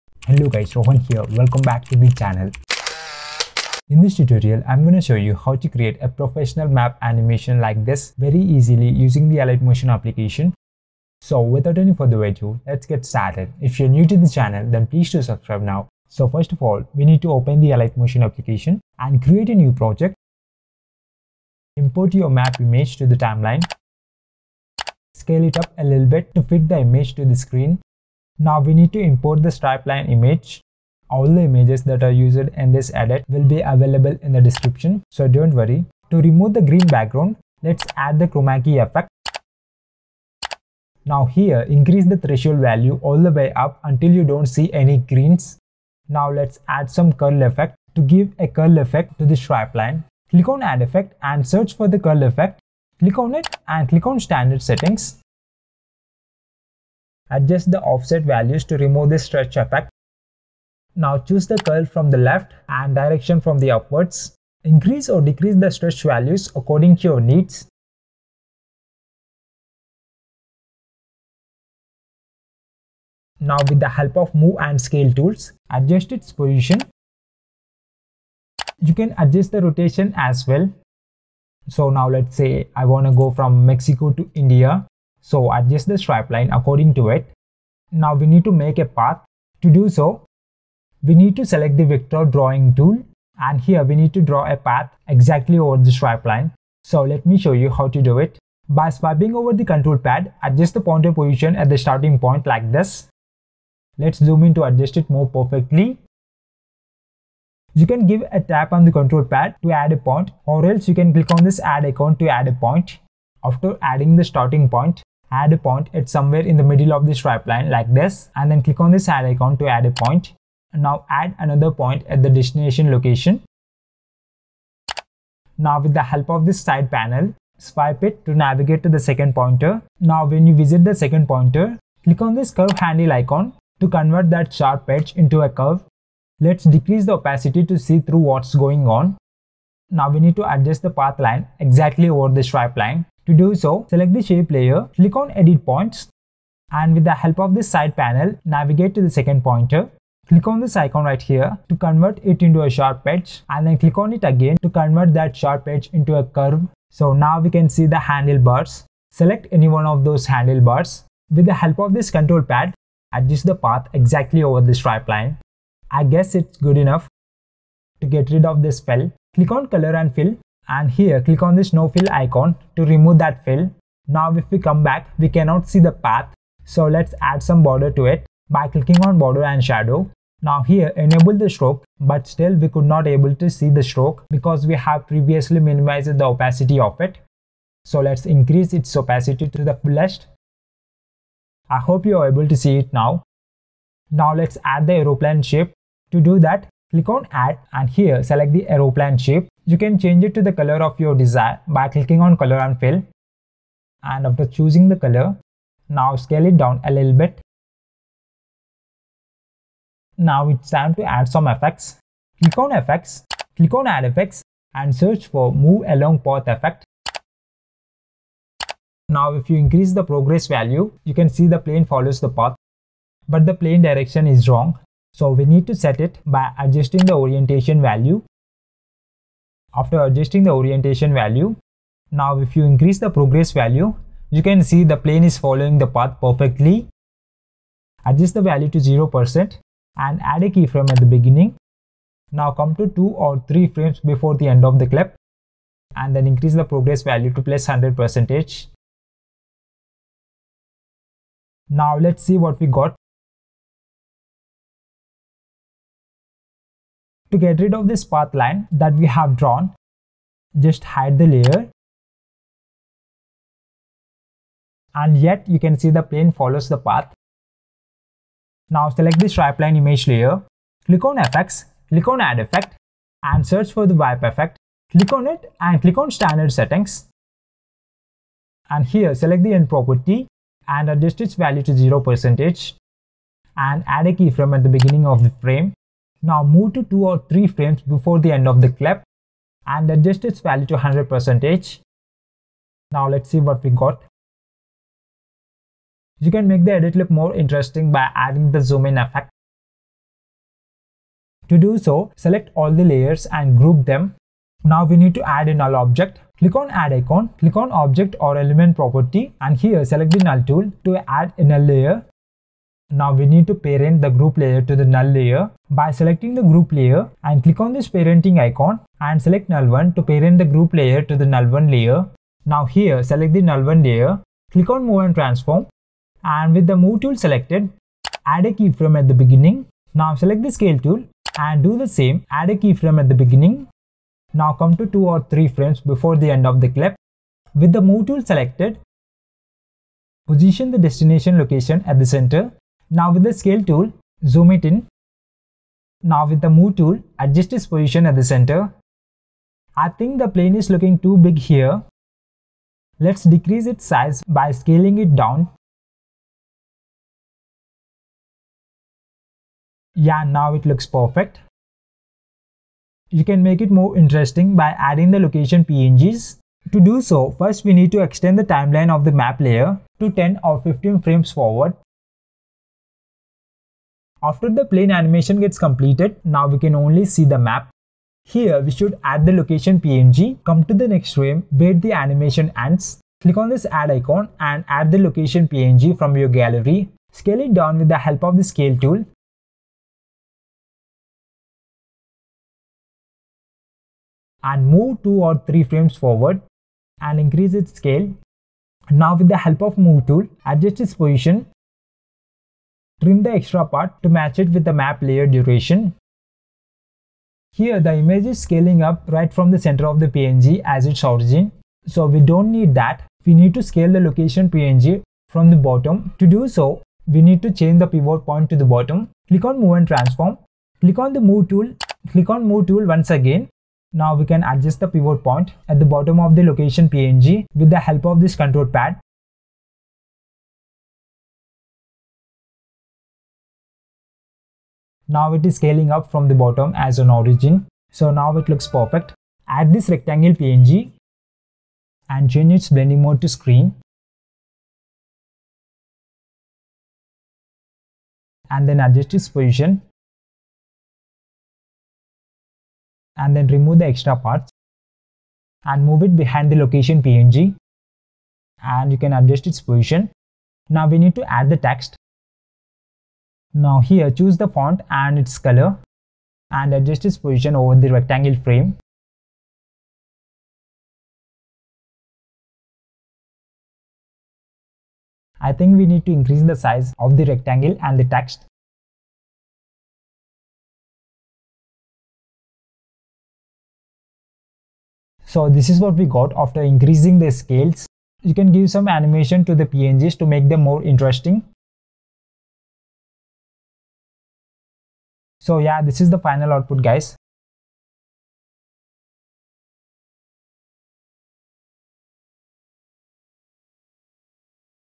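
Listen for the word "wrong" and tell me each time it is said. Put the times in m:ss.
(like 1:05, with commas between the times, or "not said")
3:44.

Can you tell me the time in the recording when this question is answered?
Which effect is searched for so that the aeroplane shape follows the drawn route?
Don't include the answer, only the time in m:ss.
3:35.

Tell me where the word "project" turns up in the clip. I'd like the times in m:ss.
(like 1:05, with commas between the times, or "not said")
0:19.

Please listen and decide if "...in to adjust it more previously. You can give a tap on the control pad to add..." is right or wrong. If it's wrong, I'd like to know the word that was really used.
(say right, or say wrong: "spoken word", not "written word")
wrong: "perfectly", not "previously".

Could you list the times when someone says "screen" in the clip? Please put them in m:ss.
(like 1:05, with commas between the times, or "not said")
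0:27, 7:23.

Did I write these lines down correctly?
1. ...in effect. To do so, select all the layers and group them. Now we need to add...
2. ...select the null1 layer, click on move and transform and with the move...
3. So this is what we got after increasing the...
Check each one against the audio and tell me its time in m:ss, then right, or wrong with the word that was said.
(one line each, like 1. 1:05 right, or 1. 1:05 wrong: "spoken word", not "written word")
1. 4:58 right
2. 5:23 right
3. 8:05 right.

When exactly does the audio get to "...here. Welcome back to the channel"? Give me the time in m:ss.
0:01.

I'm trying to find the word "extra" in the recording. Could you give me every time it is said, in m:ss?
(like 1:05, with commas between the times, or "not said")
6:43, 7:33.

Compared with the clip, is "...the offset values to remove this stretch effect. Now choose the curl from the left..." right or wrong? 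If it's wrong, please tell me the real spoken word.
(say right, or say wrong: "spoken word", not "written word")
right.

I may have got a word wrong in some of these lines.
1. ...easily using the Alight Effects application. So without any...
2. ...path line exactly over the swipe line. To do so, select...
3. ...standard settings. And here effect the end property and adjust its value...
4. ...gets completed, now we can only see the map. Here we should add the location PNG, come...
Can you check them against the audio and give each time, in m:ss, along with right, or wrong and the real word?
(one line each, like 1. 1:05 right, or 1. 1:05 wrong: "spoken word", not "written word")
1. 0:08 wrong: "Motion", not "Effects"
2. 2:20 wrong: "stripe", not "swipe"
3. 4:36 wrong: "select", not "effect"
4. 6:15 right.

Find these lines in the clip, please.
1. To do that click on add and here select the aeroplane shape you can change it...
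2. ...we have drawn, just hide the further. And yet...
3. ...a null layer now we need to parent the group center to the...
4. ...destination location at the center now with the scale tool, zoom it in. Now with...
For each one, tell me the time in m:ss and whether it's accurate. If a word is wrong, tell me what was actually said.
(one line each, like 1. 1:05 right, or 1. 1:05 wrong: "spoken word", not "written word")
1. 3:16 right
2. 4:18 wrong: "layer", not "further"
3. 5:11 wrong: "layer", not "center"
4. 5:40 right.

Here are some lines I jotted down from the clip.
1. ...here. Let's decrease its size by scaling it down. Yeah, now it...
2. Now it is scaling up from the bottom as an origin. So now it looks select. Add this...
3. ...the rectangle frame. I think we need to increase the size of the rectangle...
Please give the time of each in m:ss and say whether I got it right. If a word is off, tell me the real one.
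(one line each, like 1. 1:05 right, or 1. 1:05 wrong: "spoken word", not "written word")
1. 5:51 right
2. 7:15 wrong: "perfect", not "select"
3. 7:47 right.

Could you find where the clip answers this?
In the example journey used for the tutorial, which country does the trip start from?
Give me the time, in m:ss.
1:23.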